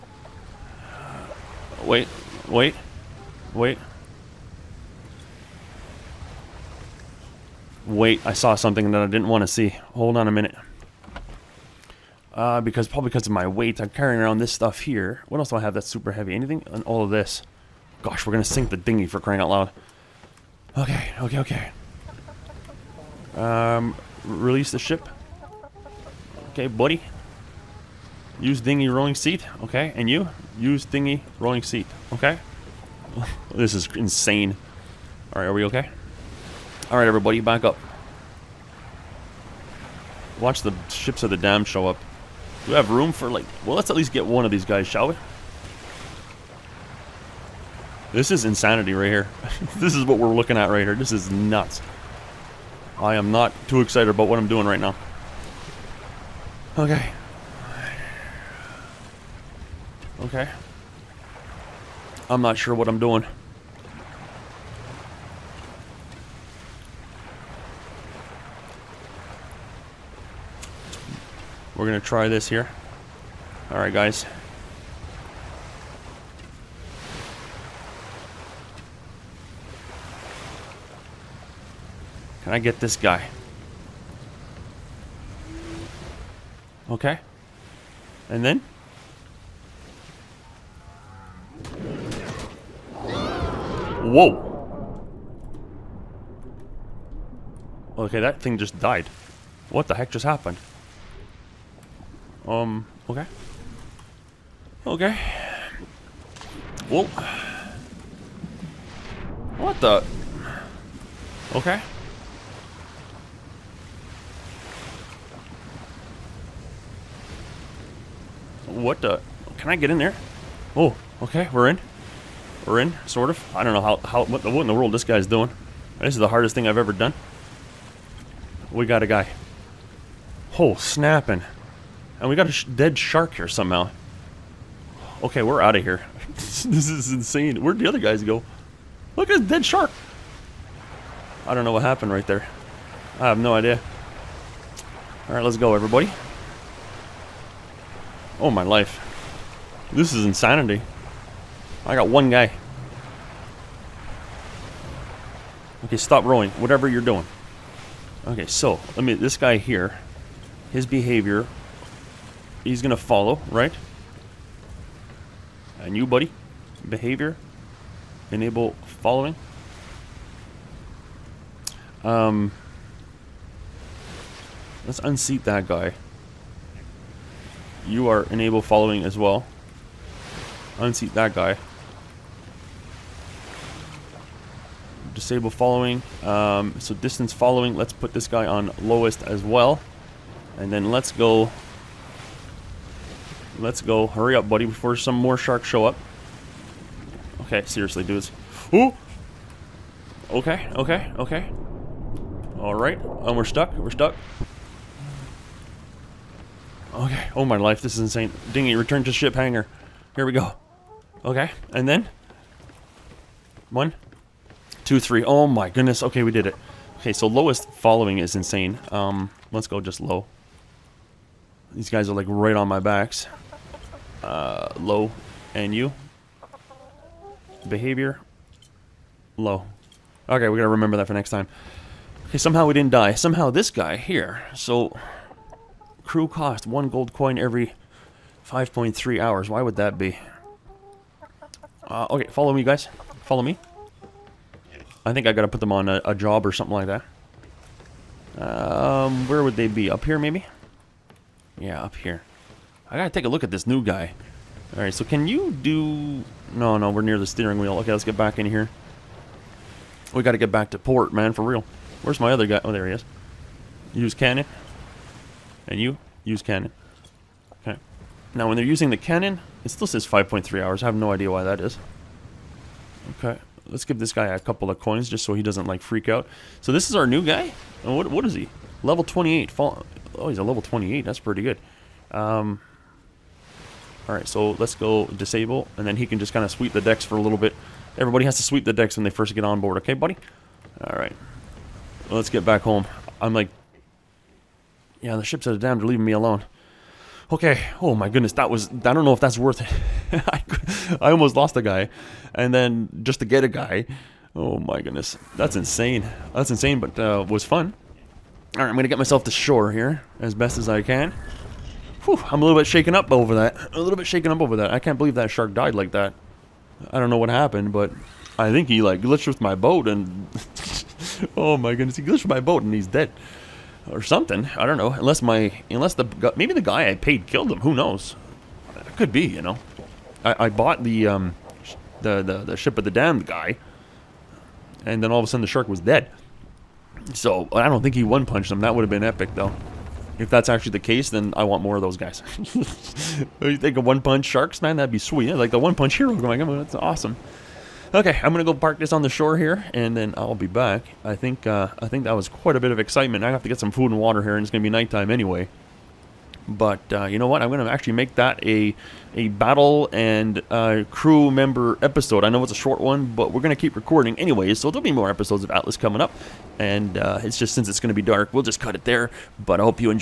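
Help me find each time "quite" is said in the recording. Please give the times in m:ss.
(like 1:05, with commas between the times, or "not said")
5:52.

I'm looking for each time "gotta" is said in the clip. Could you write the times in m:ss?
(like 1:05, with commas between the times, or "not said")
3:50, 4:05, 4:12, 4:20.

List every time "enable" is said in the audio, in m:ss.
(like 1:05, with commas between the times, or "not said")
2:48, 2:58.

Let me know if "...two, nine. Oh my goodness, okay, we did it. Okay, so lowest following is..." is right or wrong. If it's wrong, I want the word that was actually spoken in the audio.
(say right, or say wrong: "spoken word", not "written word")
wrong: "three", not "nine".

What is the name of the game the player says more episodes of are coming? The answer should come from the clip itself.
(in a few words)
Atlas.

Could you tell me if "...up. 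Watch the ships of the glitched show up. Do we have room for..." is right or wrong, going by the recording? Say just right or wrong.
wrong.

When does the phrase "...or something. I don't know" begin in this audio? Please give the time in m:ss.
5:23.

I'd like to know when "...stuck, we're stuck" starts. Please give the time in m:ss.
3:23.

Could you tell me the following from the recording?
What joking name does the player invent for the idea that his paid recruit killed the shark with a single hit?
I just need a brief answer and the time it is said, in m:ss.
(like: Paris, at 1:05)
One Punch Sharks, at 5:43.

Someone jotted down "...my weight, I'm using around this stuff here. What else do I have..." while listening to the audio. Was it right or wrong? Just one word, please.
wrong.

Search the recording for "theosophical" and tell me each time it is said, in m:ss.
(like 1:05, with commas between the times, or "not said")
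not said.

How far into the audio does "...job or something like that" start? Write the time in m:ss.
4:06.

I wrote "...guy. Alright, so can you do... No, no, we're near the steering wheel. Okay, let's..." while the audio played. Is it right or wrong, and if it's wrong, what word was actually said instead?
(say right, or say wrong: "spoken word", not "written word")
right.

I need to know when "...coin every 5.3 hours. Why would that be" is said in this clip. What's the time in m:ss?
3:57.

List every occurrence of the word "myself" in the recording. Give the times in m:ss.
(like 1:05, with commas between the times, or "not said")
5:08.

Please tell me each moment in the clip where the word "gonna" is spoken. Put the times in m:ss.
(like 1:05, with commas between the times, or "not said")
0:18, 2:42, 5:08, 5:48, 5:54.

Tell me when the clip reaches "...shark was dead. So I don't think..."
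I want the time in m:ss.
5:35.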